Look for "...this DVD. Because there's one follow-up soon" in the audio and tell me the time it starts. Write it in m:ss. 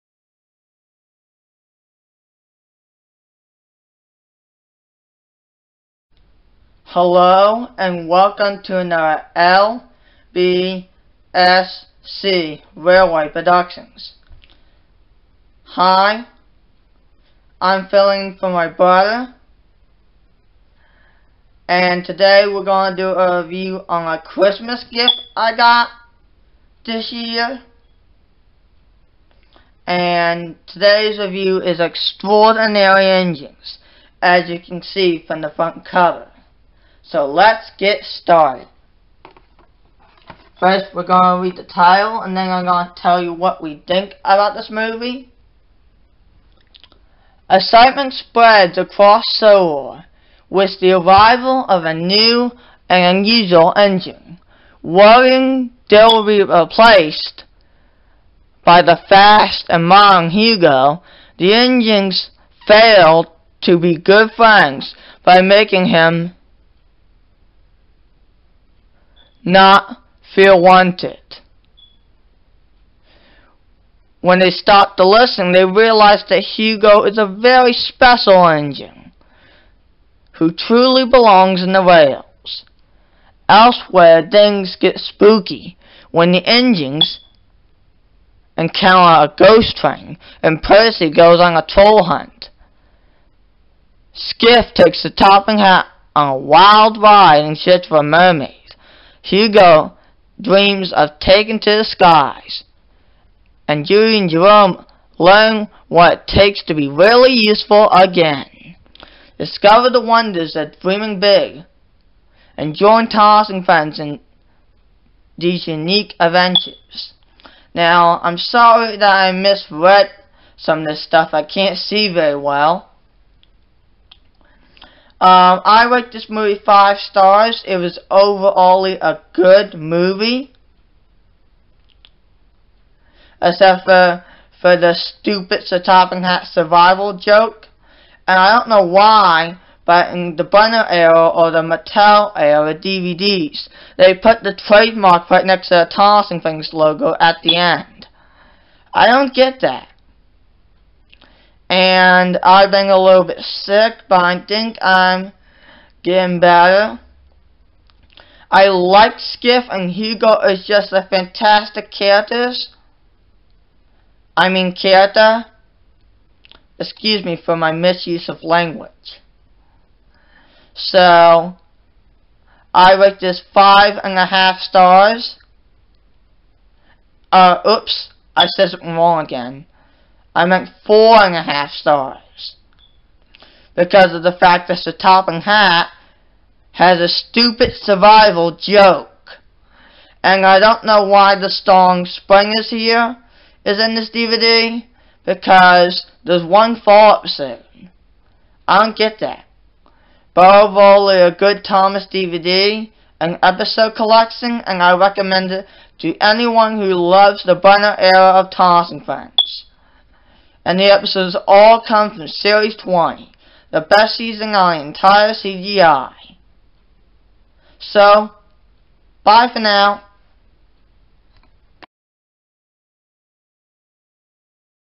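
3:13.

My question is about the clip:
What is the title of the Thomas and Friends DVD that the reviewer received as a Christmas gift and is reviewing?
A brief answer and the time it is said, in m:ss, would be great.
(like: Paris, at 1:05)
Extraordinary Engines, at 0:31.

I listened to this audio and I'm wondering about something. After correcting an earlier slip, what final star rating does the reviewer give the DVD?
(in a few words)
4.5 stars.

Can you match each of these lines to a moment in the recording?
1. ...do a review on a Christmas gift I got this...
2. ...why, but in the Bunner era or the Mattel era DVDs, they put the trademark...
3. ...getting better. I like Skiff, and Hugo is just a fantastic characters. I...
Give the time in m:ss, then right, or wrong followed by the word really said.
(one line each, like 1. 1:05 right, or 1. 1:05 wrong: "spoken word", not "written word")
1. 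0:23 right
2. 2:18 right
3. 2:36 right.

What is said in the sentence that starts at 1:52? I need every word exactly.
And join Thomas and friends in these unique adventures.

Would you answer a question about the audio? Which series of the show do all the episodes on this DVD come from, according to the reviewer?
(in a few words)
Series 20.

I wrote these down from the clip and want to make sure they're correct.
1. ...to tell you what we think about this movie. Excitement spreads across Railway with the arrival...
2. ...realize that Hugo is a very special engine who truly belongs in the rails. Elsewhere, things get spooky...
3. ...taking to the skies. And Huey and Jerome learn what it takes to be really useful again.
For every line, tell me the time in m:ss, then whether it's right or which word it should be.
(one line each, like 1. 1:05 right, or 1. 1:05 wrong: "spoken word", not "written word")
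1. 0:42 wrong: "Sodor", not "Railway"
2. 1:15 right
3. 1:41 right.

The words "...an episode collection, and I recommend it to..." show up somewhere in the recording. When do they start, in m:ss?
3:23.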